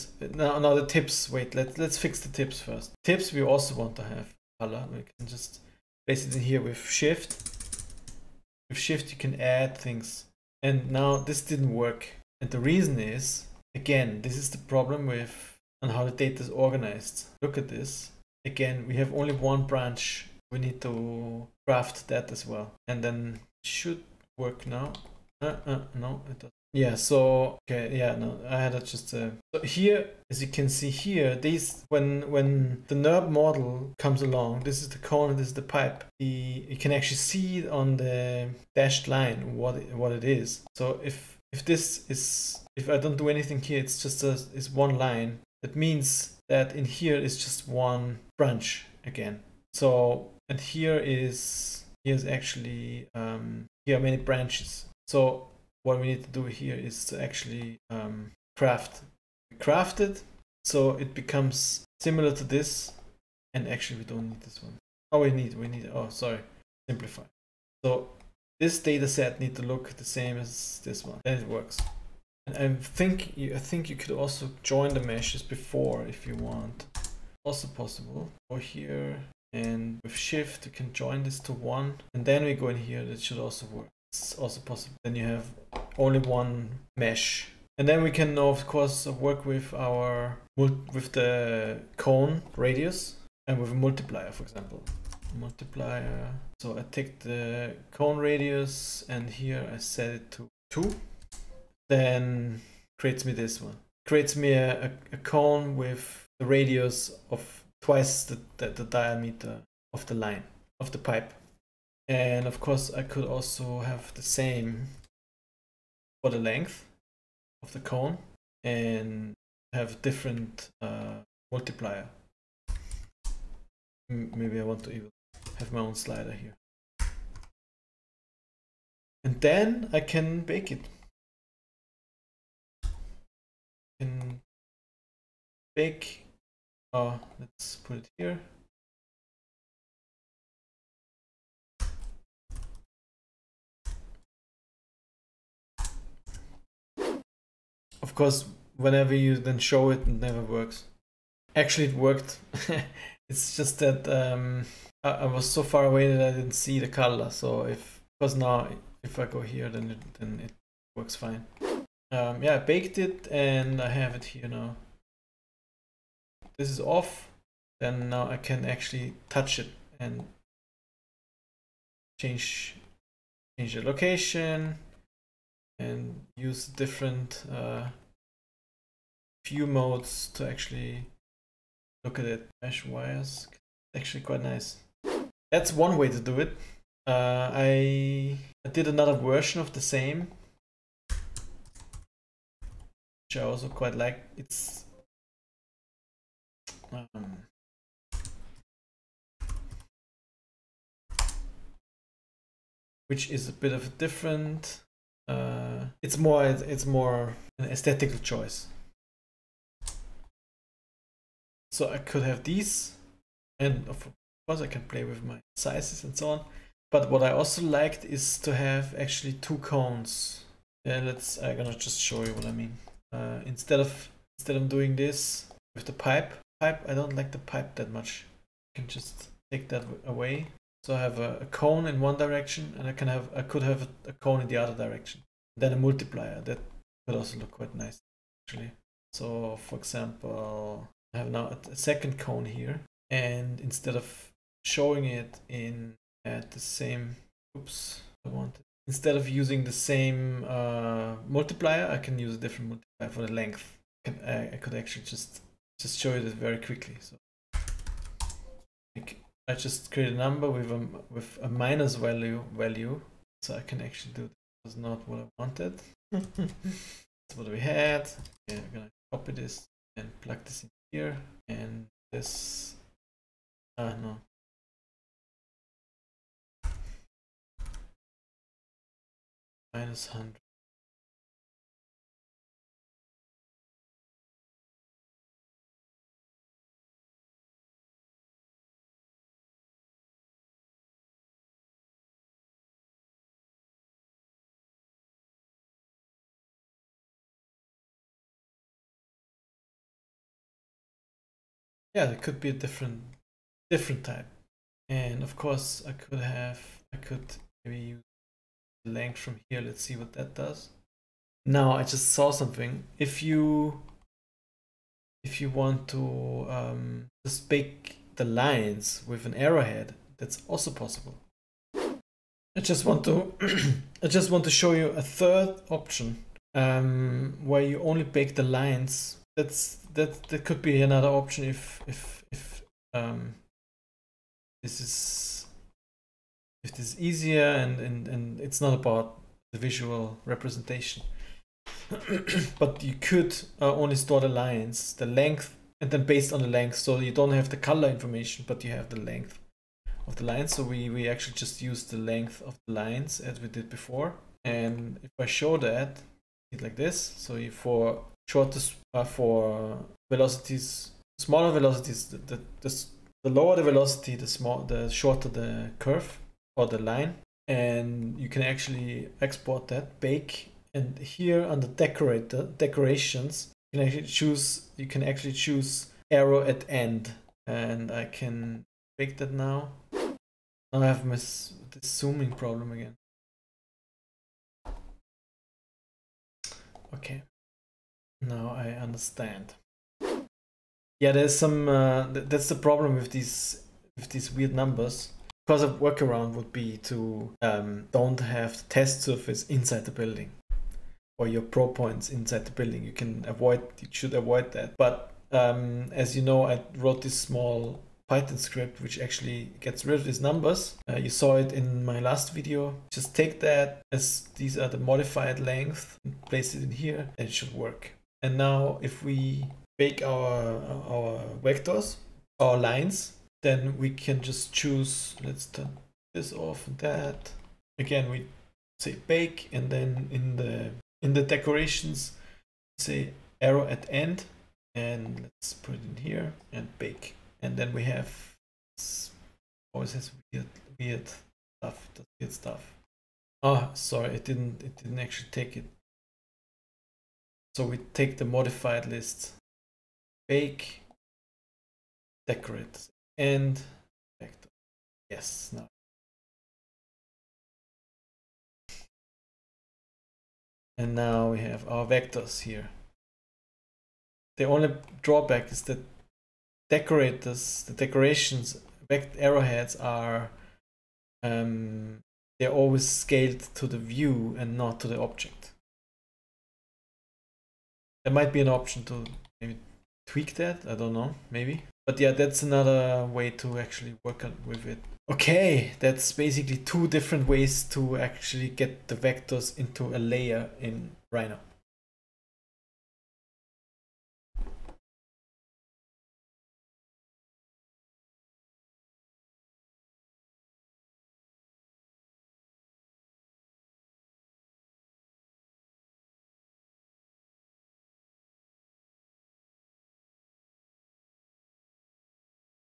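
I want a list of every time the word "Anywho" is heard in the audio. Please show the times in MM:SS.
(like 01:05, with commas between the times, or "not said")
not said.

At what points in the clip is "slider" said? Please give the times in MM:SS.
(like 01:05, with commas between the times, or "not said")
02:05.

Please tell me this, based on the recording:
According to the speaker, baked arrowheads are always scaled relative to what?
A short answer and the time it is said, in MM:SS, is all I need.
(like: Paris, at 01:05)
The view, at 07:53.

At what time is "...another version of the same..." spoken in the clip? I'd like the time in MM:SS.
03:08.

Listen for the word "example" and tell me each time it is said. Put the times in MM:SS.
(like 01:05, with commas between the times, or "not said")
01:34, 03:59.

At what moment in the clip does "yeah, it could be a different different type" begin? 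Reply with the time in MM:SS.
05:01.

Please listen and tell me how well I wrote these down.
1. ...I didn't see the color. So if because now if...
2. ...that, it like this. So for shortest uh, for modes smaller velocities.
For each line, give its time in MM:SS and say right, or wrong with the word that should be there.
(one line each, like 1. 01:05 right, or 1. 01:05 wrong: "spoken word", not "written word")
1. 02:36 right
2. 05:55 wrong: "velocities", not "modes".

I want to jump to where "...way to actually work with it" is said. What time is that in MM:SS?
08:03.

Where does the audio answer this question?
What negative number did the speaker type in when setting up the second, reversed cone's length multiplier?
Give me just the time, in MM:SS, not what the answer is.
04:39.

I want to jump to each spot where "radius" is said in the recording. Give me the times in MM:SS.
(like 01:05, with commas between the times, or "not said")
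01:32, 01:38, 01:46.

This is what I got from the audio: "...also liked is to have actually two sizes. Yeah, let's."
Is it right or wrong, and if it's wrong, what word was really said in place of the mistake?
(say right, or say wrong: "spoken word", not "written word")
wrong: "cones", not "sizes".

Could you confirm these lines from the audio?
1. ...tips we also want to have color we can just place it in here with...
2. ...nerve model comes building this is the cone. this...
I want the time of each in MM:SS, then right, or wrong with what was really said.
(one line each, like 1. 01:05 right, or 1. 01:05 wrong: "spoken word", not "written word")
1. 00:03 right
2. 00:32 wrong: "along", not "building".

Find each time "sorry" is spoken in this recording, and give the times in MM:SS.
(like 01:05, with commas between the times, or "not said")
01:06, 07:23.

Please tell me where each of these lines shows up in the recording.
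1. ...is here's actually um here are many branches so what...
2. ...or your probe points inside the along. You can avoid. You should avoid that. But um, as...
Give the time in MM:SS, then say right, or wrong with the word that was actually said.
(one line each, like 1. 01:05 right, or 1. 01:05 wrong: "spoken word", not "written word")
1. 00:50 right
2. 06:41 wrong: "building", not "along".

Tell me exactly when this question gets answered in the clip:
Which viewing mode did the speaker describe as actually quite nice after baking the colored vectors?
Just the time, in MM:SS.
03:02.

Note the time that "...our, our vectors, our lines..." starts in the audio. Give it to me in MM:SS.
07:00.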